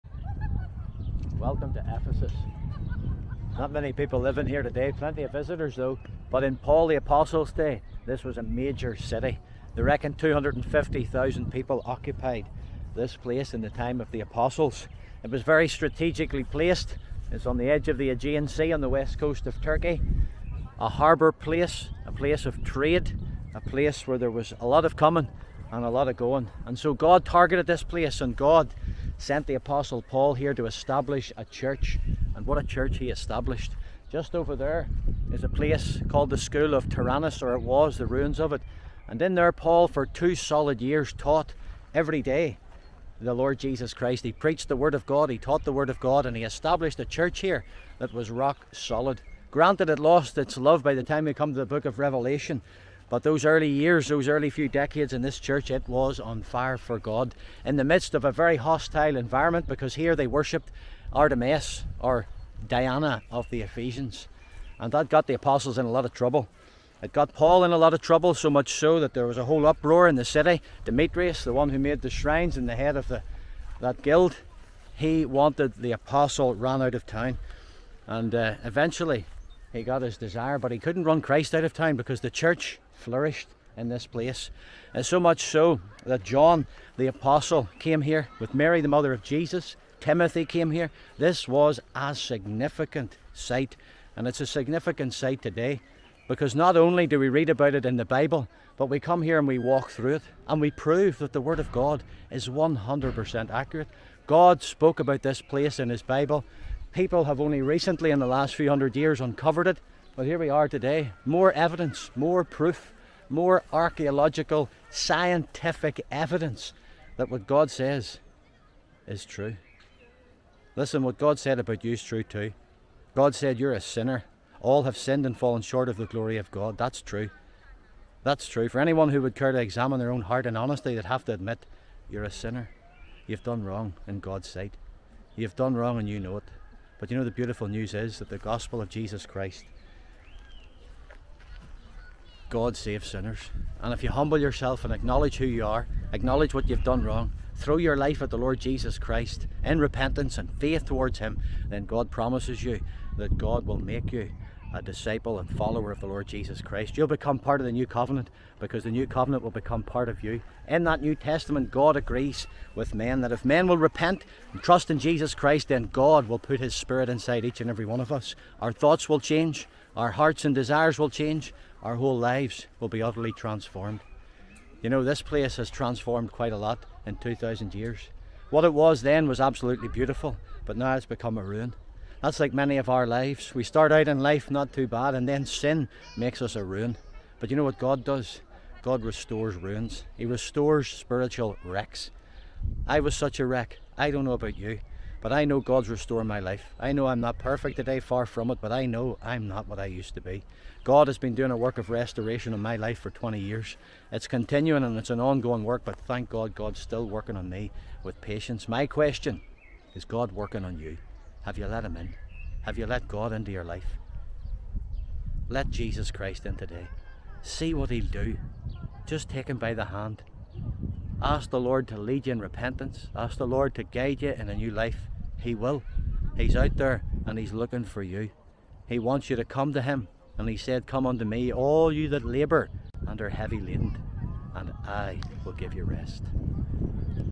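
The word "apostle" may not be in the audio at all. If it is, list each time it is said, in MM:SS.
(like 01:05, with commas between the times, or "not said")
00:06, 00:14, 00:29, 01:05, 01:15, 01:27.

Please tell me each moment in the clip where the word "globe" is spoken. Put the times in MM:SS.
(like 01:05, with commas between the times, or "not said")
not said.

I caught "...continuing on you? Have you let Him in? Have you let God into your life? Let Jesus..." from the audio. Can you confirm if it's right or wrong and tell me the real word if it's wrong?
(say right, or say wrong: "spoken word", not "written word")
wrong: "working", not "continuing".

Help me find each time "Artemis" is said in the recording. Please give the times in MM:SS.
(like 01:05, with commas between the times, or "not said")
01:01.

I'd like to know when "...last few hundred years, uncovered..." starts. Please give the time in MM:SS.
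01:48.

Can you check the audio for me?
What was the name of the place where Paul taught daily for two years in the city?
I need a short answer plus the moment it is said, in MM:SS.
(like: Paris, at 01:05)
School of Tyrannus, at 00:36.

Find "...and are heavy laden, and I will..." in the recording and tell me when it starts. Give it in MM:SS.
03:53.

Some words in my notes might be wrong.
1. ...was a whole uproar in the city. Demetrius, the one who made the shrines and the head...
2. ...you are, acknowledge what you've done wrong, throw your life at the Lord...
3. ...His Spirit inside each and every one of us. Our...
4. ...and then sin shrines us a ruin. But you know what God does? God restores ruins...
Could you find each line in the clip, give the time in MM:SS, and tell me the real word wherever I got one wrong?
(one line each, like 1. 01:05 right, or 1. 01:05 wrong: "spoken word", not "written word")
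1. 01:09 right
2. 02:25 right
3. 02:46 right
4. 03:05 wrong: "makes", not "shrines".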